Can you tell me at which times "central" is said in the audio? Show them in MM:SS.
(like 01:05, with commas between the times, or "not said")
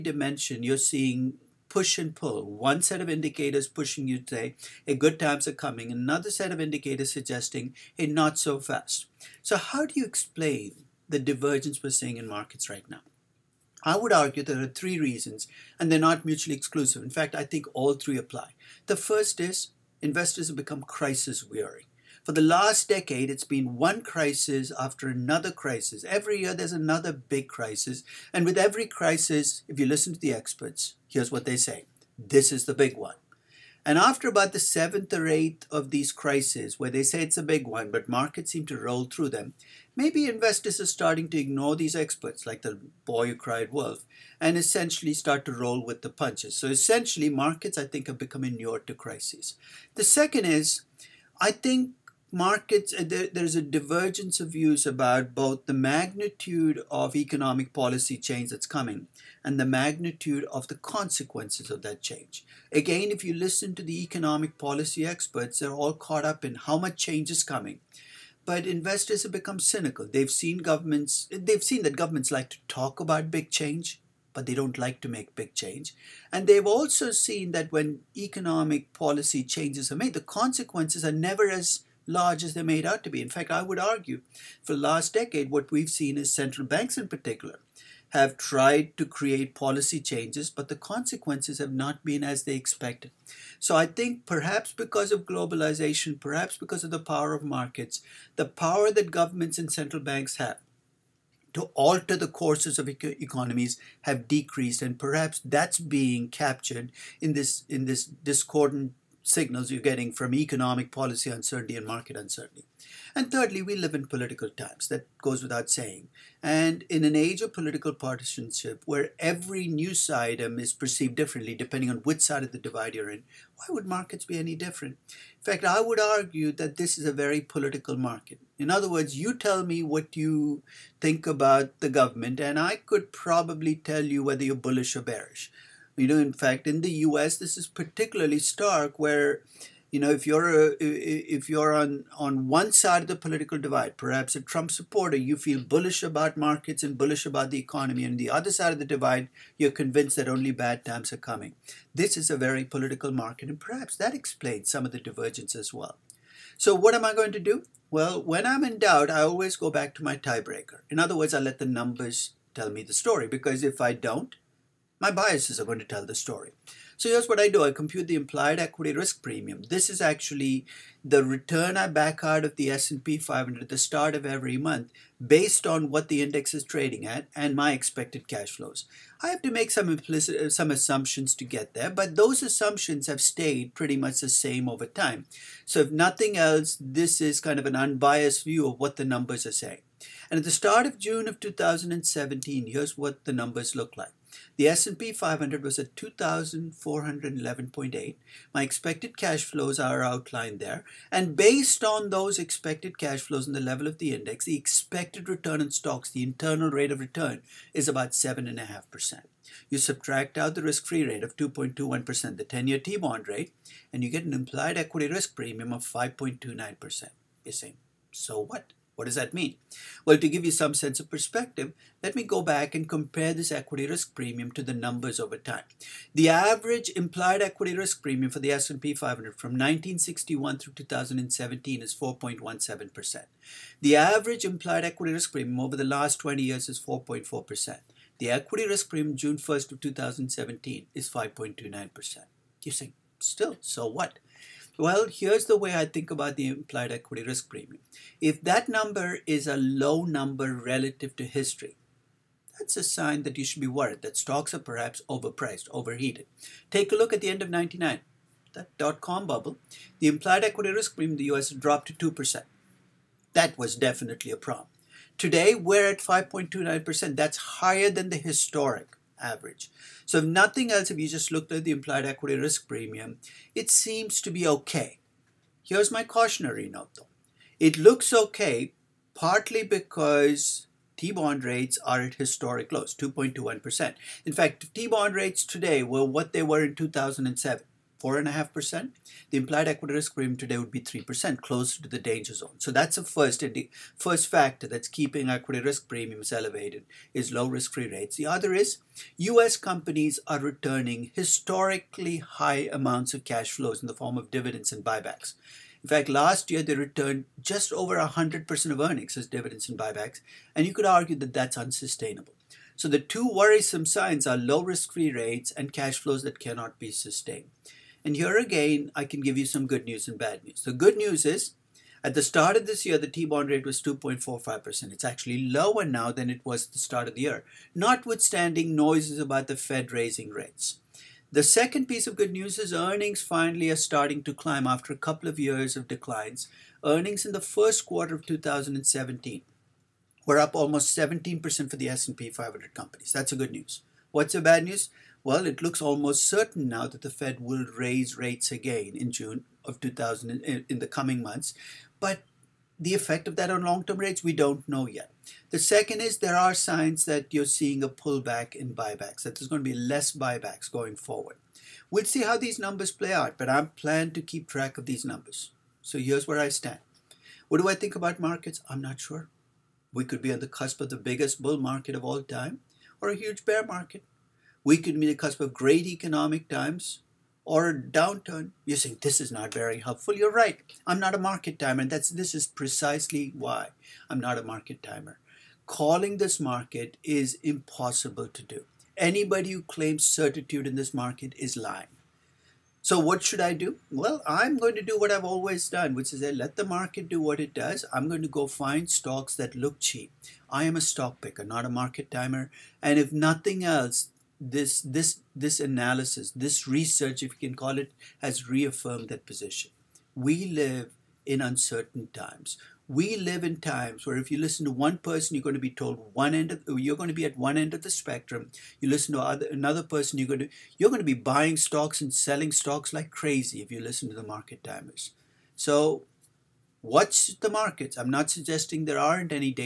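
01:26, 01:39.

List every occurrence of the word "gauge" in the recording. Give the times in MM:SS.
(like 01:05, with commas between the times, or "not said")
not said.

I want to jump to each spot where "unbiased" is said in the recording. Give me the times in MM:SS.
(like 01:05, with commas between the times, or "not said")
03:07.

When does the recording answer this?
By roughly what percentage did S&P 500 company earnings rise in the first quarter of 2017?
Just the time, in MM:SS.
05:40.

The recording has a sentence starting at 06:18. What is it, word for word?
You're saying this is not very helpful.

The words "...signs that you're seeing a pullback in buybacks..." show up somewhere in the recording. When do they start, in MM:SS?
05:56.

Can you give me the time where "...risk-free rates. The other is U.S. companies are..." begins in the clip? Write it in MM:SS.
04:57.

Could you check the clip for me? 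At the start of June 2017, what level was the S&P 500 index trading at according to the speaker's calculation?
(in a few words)
2,411.8.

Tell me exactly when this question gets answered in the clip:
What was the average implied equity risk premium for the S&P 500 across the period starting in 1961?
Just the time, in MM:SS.
03:51.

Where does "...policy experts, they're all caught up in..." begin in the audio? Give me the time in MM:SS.
01:04.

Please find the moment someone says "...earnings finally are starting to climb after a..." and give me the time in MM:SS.
05:32.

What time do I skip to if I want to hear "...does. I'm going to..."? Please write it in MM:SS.
06:37.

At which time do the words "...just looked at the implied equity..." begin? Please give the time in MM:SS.
04:31.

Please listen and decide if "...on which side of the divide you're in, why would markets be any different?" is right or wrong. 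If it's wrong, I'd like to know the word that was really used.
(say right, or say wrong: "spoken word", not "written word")
right.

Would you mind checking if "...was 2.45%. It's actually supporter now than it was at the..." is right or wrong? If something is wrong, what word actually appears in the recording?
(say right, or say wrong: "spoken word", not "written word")
wrong: "lower", not "supporter".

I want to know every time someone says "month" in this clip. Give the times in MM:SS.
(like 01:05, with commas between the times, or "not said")
02:54, 05:51.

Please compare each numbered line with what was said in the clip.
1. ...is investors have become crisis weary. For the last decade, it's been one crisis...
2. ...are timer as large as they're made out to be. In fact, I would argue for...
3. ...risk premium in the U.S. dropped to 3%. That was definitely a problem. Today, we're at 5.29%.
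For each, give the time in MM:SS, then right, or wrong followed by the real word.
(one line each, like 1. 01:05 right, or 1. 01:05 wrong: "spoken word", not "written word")
1. 00:19 right
2. 01:21 wrong: "never", not "timer"
3. 04:20 wrong: "2", not "3".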